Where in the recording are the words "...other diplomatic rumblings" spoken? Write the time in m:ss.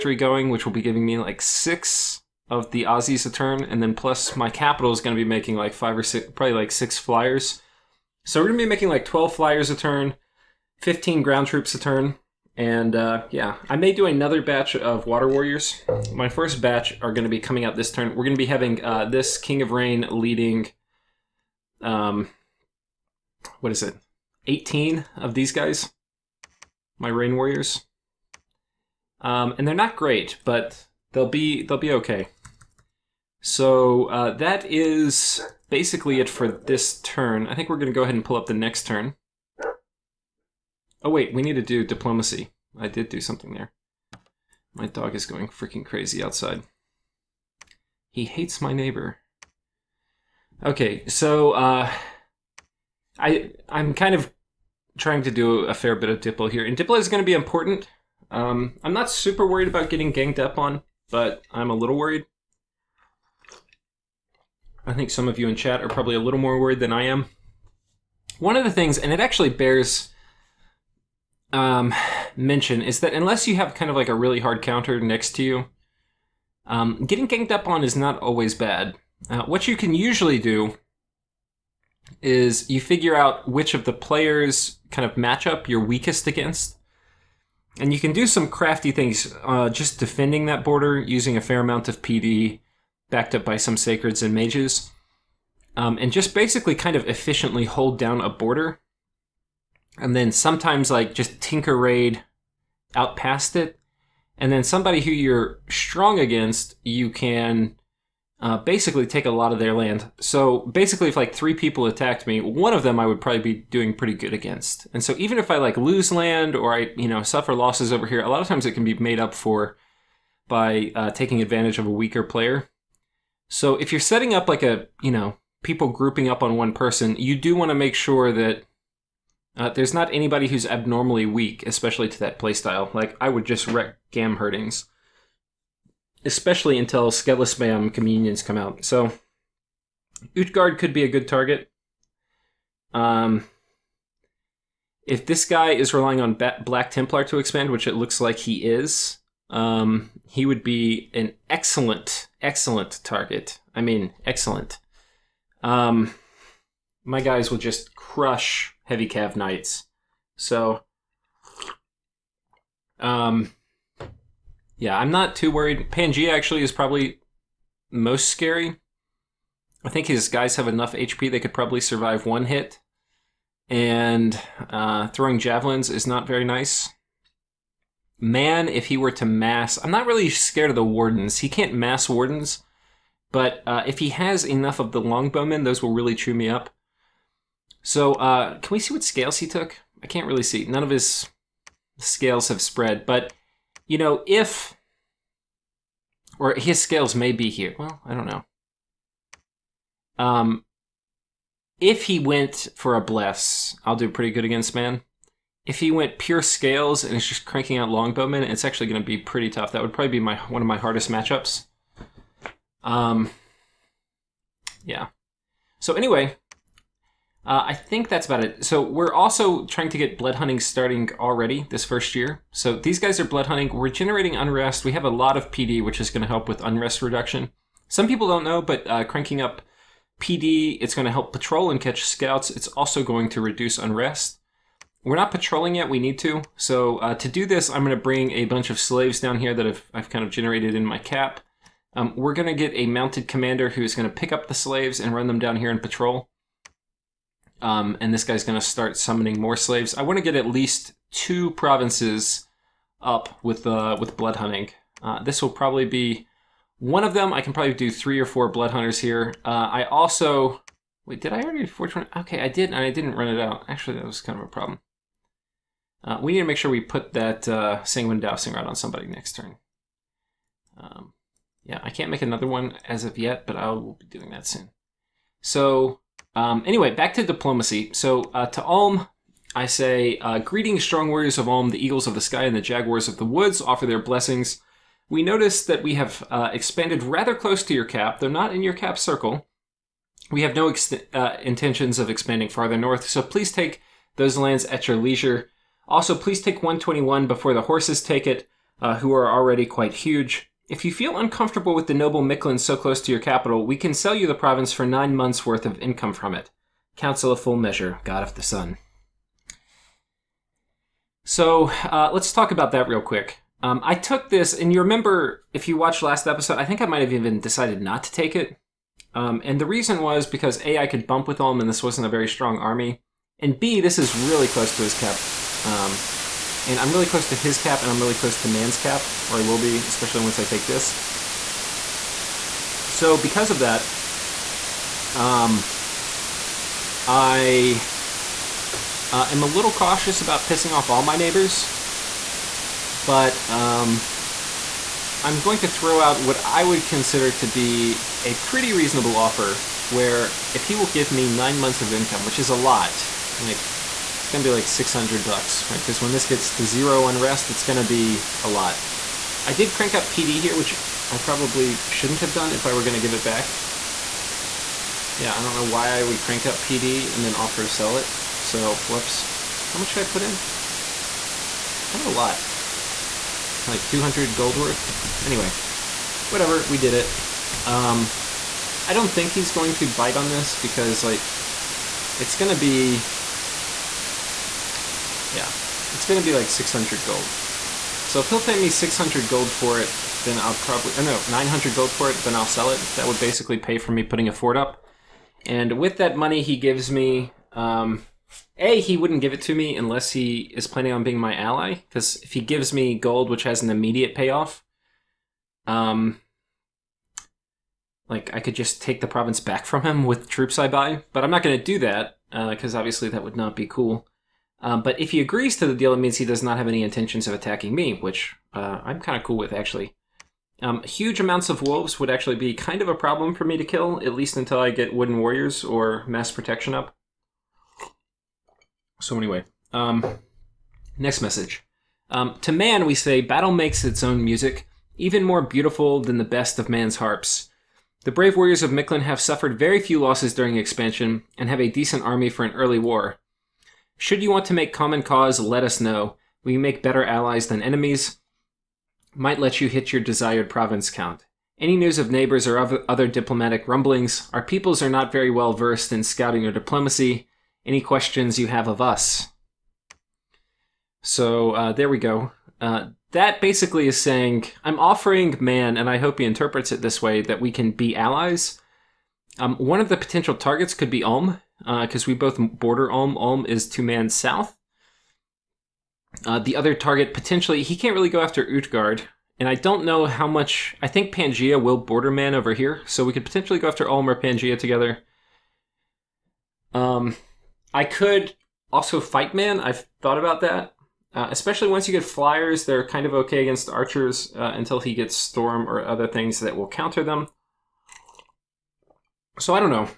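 7:32.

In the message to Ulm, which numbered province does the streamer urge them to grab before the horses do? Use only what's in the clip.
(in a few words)
121.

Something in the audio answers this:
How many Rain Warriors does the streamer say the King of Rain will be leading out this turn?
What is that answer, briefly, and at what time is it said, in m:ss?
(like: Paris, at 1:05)
18, at 0:24.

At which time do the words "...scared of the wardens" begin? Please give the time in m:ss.
3:00.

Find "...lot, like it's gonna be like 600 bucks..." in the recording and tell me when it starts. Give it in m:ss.
5:52.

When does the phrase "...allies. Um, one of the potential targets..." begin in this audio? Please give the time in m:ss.
7:47.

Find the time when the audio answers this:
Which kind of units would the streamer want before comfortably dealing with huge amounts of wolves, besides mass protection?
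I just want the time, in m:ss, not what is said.
7:04.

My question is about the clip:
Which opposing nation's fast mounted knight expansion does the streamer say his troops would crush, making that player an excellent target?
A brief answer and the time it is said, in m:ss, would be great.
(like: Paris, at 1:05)
Black Templar, at 2:26.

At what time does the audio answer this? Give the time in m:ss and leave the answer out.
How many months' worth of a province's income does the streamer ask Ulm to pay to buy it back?
5:04.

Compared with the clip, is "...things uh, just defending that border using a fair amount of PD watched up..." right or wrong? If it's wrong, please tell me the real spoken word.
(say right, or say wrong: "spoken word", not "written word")
wrong: "backed", not "watched".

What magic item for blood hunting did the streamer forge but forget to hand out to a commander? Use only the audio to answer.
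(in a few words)
sanguine dowsing rod.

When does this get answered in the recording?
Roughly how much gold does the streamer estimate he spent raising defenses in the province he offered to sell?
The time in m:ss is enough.
6:13.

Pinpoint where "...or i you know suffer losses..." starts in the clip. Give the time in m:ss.
1:56.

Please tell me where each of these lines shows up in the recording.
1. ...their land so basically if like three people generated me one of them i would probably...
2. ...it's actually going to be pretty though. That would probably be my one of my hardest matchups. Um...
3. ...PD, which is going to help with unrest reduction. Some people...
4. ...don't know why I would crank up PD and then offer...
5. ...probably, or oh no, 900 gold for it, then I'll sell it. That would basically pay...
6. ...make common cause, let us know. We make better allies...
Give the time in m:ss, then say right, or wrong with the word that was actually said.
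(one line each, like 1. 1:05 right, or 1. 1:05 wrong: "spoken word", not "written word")
1. 1:49 wrong: "attacked", not "generated"
2. 3:28 wrong: "tough", not "though"
3. 3:45 right
4. 6:05 right
5. 6:30 right
6. 7:24 right.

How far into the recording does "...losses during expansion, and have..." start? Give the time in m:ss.
7:20.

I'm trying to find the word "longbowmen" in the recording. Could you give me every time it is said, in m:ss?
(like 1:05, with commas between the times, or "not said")
3:05, 3:27.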